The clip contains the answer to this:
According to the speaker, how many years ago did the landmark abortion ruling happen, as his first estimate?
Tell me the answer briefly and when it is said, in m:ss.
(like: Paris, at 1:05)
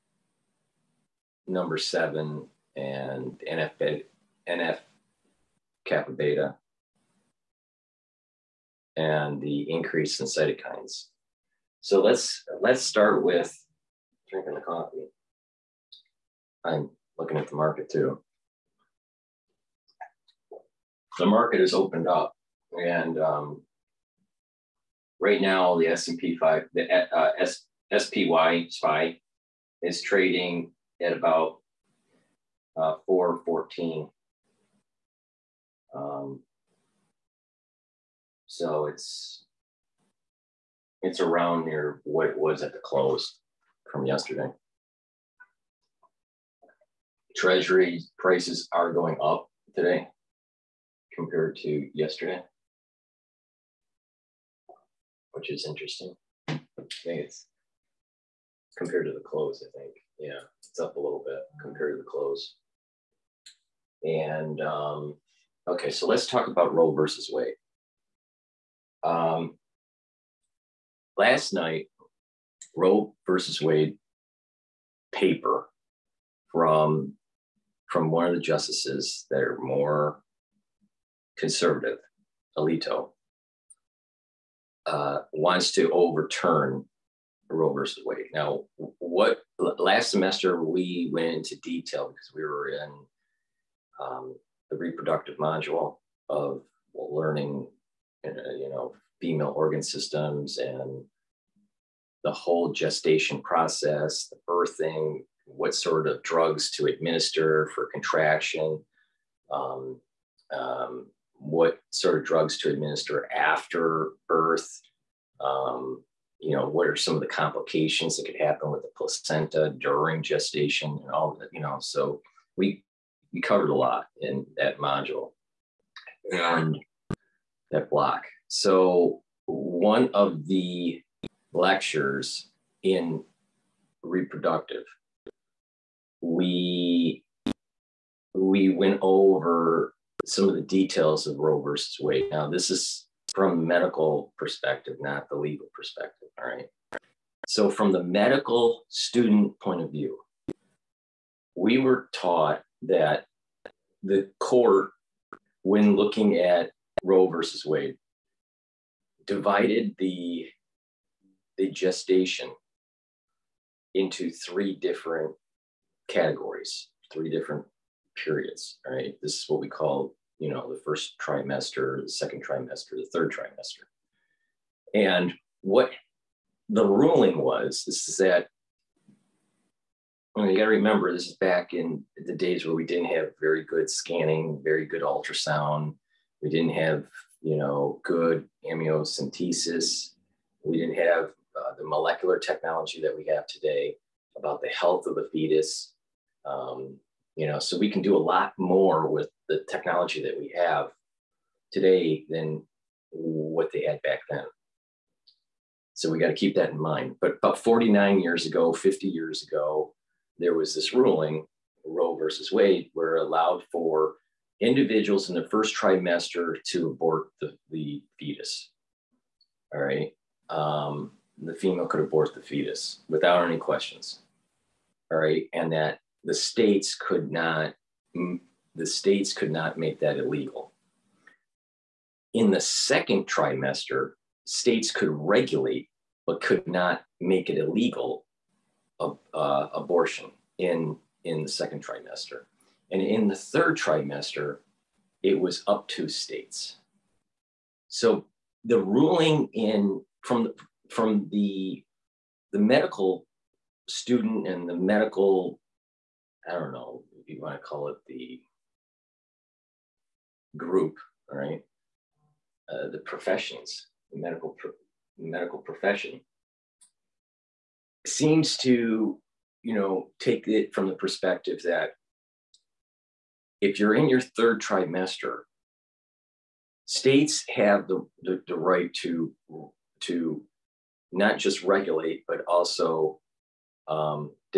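49, at 3:27.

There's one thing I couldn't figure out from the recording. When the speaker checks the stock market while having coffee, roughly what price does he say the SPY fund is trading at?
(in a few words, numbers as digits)
414.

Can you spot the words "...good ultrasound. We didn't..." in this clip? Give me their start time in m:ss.
3:04.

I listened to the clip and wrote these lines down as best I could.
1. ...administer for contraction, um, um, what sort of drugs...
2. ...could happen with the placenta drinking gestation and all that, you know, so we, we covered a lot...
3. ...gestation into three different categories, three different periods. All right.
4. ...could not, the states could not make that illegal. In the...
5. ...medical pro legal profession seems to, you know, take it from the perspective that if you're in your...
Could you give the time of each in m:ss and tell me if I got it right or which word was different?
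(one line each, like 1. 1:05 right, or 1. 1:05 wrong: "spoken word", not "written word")
1. 1:46 right
2. 1:58 wrong: "during", not "drinking"
3. 2:41 right
4. 3:46 right
5. 4:24 wrong: "medical", not "legal".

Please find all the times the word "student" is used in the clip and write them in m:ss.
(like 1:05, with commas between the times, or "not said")
2:28, 4:13.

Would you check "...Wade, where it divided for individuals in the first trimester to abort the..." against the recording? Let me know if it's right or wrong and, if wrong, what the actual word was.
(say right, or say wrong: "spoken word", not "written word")
wrong: "allowed", not "divided".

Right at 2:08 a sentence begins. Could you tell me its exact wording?
So one of the lectures in reproductive, we we went over some of the details of Roe versus Wade.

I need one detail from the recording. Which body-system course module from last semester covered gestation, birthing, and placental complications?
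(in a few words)
reproductive module.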